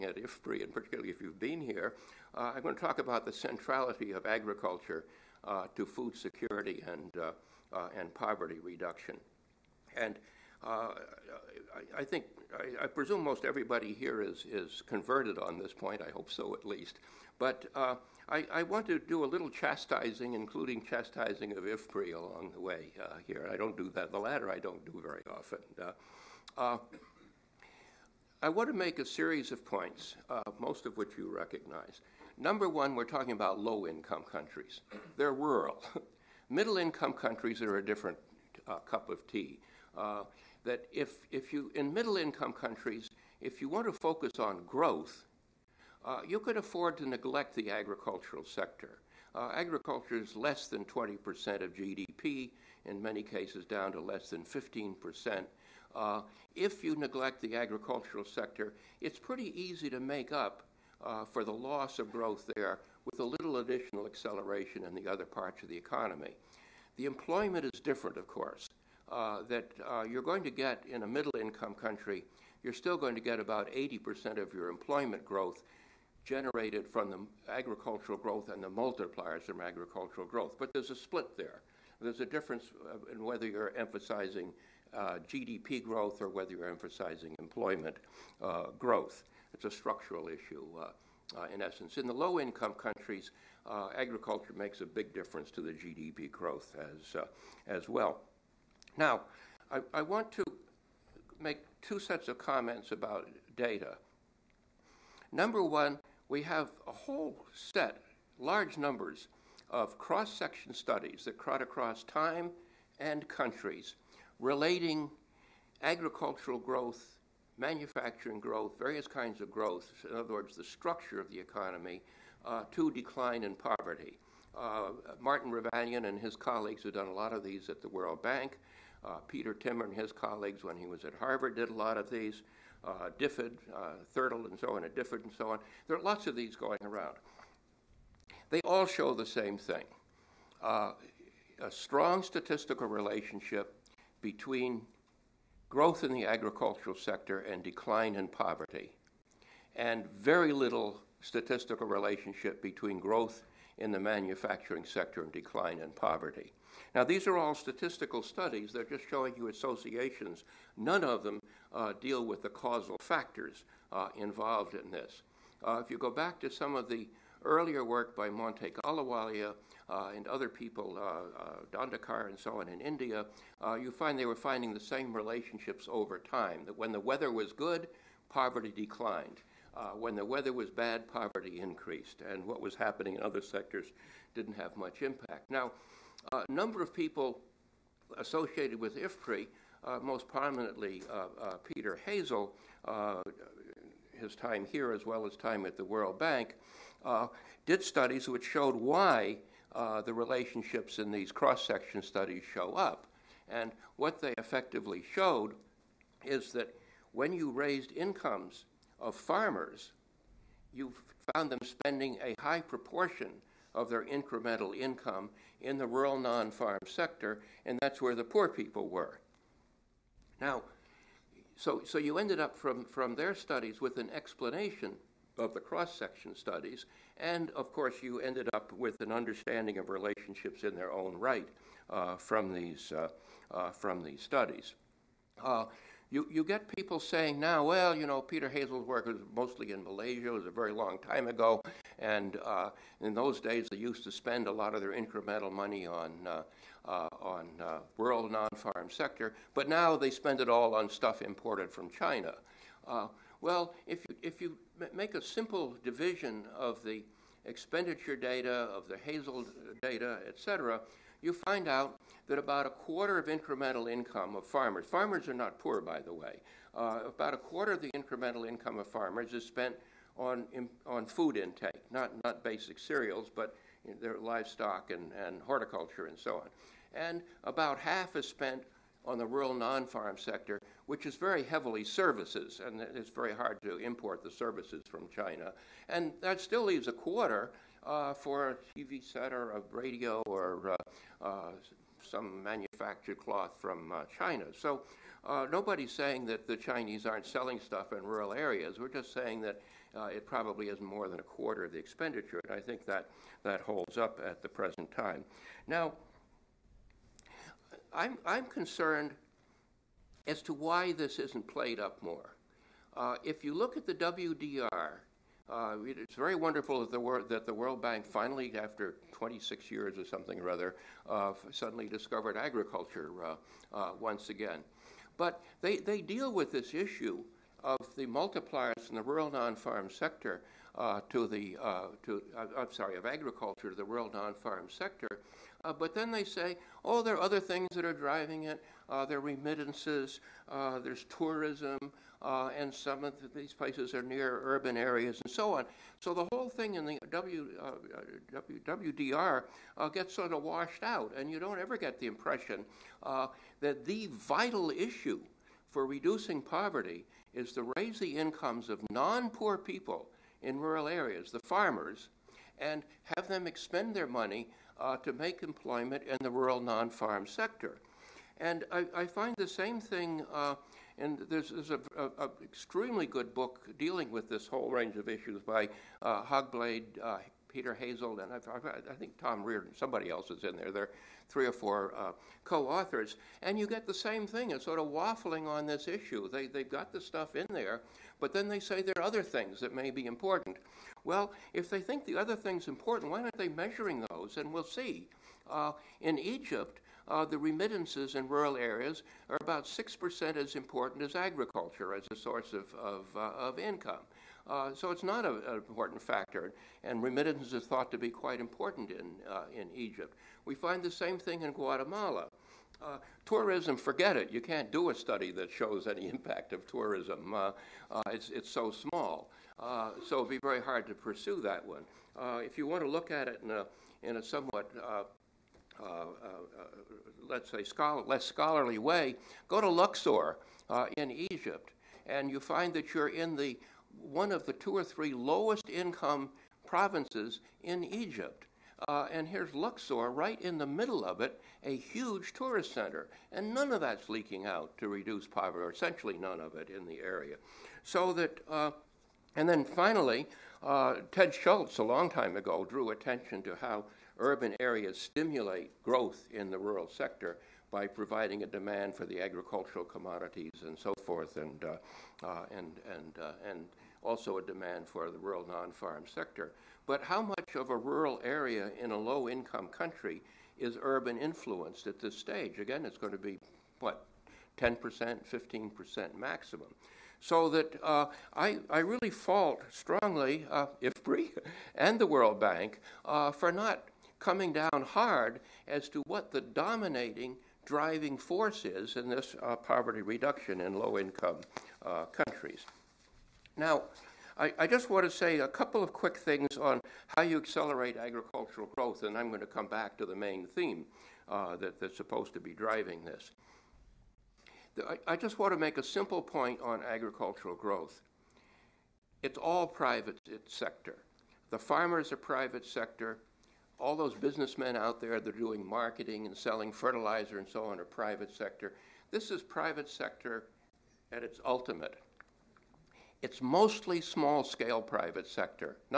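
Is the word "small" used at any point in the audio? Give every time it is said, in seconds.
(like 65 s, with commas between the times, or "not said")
418 s, 524 s.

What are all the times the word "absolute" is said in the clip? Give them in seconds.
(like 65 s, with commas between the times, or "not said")
not said.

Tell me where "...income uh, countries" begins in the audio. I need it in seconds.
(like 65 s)
490 s.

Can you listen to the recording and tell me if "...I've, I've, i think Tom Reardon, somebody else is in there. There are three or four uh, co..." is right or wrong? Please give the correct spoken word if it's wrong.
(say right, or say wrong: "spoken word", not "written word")
right.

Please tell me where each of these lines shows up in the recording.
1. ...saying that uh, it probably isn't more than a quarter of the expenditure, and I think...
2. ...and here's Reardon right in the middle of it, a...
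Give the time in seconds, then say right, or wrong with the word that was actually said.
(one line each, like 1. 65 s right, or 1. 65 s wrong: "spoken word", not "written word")
1. 299 s right
2. 439 s wrong: "Luxor", not "Reardon".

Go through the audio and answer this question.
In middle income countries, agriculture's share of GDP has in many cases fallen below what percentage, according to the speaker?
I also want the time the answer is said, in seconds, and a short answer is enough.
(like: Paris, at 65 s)
15%, at 54 s.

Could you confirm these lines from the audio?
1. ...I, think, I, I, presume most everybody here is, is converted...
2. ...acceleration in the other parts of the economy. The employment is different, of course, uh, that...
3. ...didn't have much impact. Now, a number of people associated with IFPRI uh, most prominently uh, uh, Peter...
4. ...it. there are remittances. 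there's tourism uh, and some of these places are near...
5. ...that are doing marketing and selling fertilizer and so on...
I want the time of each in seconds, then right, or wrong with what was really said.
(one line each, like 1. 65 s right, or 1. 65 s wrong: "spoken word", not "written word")
1. 11 s right
2. 64 s right
3. 184 s right
4. 338 s right
5. 515 s right.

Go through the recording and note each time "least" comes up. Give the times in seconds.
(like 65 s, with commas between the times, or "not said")
16 s.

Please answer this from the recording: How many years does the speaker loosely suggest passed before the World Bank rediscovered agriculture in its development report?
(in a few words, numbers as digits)
26.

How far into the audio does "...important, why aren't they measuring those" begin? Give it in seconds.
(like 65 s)
392 s.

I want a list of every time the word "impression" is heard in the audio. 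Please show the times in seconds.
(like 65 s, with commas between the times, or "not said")
352 s.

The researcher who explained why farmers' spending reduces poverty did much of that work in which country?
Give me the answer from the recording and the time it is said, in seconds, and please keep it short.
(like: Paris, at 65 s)
Malaysia, at 239 s.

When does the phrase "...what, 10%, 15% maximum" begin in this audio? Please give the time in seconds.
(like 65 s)
473 s.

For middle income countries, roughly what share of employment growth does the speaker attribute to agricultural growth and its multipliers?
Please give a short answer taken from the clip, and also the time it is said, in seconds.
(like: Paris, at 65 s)
80%, at 73 s.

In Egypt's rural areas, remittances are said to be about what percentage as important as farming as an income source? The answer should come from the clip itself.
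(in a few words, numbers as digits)
6%.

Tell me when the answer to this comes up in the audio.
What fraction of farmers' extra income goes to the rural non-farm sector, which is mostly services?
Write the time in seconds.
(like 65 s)
277 s.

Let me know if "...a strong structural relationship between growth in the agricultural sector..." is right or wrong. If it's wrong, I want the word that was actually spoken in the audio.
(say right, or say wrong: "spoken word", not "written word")
wrong: "statistical", not "structural".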